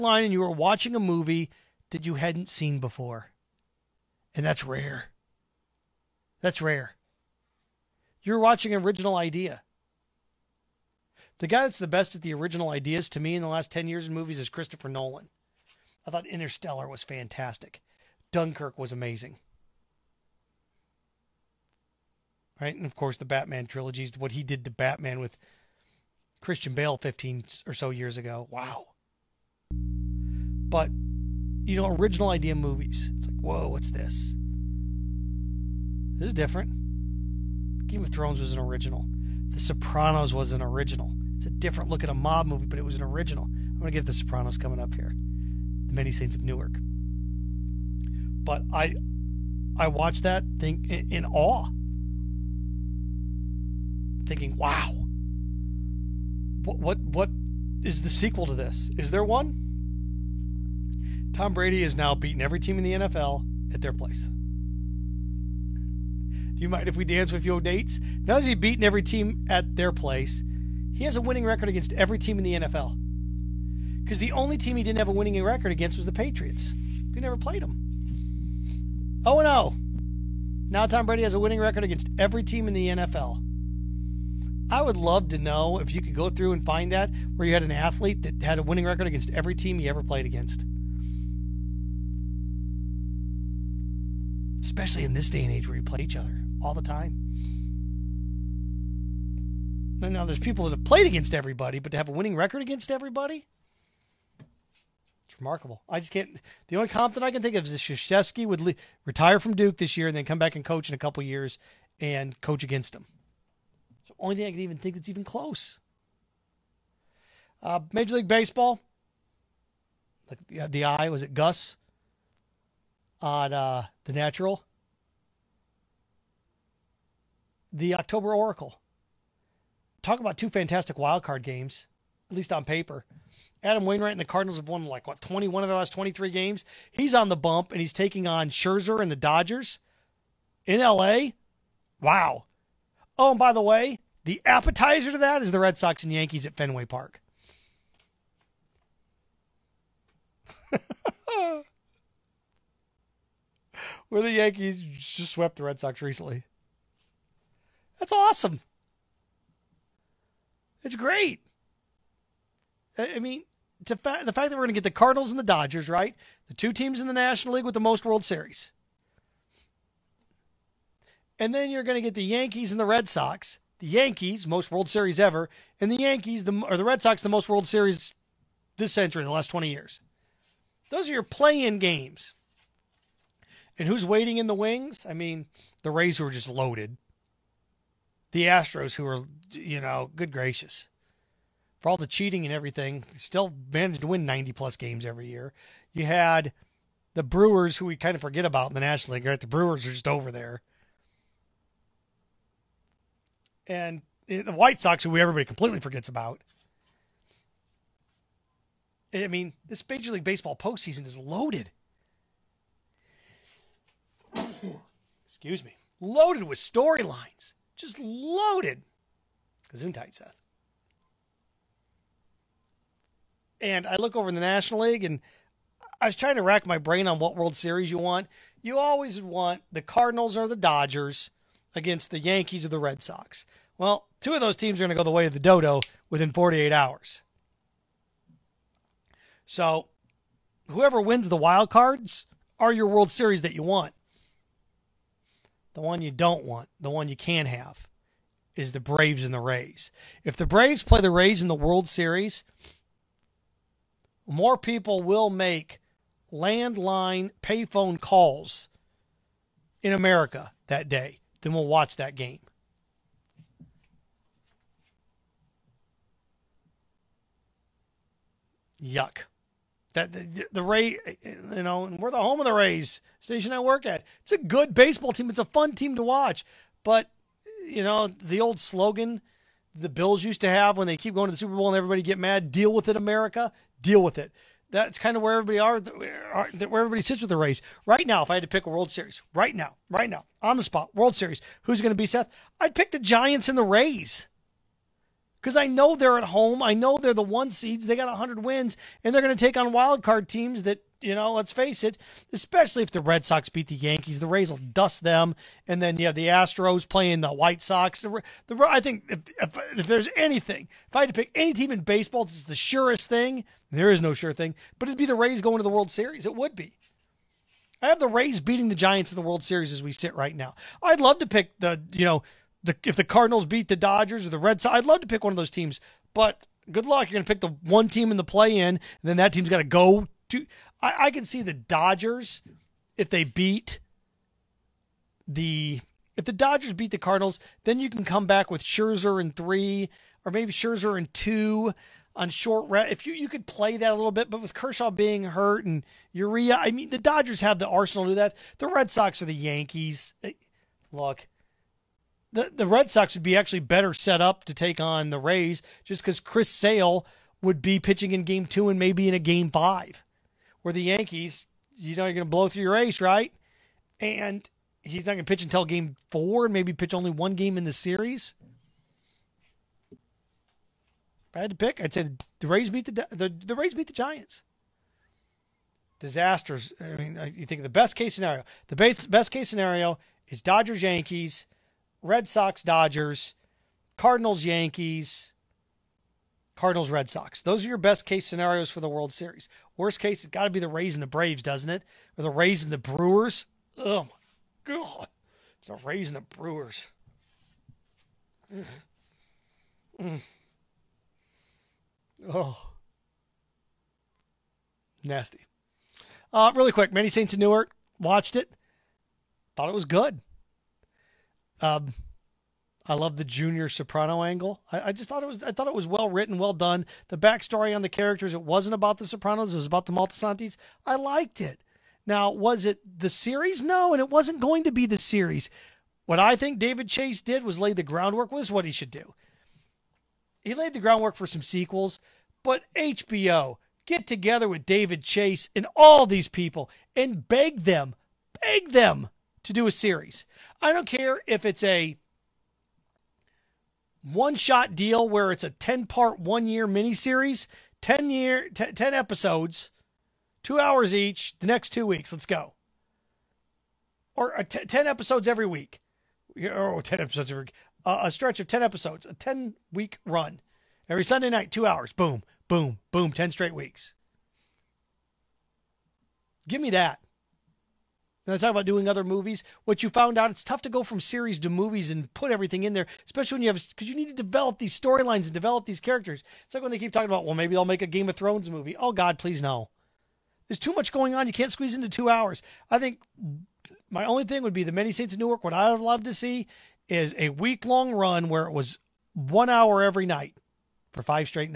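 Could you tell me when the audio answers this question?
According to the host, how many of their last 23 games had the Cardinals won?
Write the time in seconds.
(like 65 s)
135 s.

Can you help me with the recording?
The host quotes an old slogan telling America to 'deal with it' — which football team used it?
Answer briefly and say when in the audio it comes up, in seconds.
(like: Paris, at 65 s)
the Bills, at 279 s.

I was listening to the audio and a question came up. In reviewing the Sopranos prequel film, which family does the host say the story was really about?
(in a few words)
the Moltisantis.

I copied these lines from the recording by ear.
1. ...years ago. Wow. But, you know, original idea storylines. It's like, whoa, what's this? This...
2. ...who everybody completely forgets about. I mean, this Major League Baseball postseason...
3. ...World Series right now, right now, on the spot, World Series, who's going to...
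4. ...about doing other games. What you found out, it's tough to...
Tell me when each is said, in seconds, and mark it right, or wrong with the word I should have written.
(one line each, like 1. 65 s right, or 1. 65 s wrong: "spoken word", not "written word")
1. 27 s wrong: "movies", not "storylines"
2. 205 s right
3. 288 s right
4. 468 s wrong: "movies", not "games".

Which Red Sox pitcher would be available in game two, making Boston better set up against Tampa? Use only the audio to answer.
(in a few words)
Chris Sale.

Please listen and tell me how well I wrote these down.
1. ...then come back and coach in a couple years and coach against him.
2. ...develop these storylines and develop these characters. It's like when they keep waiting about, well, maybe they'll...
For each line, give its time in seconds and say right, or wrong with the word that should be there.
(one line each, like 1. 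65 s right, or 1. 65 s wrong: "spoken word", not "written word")
1. 110 s right
2. 474 s wrong: "talking", not "waiting".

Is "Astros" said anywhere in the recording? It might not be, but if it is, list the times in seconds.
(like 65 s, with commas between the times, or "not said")
188 s, 306 s.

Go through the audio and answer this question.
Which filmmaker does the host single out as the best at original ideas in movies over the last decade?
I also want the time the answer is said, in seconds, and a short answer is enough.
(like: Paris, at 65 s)
Christopher Nolan, at 14 s.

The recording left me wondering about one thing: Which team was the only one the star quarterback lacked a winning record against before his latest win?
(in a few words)
Patriots.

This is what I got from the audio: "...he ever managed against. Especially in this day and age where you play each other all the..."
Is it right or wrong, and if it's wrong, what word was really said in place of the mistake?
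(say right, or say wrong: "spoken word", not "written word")
wrong: "played", not "managed".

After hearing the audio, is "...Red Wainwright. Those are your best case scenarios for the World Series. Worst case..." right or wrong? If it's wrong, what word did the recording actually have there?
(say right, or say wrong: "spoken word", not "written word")
wrong: "Sox", not "Wainwright".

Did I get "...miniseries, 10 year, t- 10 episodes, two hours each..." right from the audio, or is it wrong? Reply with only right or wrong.
right.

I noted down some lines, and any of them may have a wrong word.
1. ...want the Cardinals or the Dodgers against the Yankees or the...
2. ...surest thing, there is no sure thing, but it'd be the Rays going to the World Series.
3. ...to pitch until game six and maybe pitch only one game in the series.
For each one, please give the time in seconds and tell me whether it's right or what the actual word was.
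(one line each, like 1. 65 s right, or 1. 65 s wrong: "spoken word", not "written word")
1. 229 s right
2. 312 s right
3. 365 s wrong: "four", not "six".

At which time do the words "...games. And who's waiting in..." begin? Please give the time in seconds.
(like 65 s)
181 s.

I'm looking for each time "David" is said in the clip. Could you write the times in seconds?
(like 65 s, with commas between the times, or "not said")
426 s, 434 s.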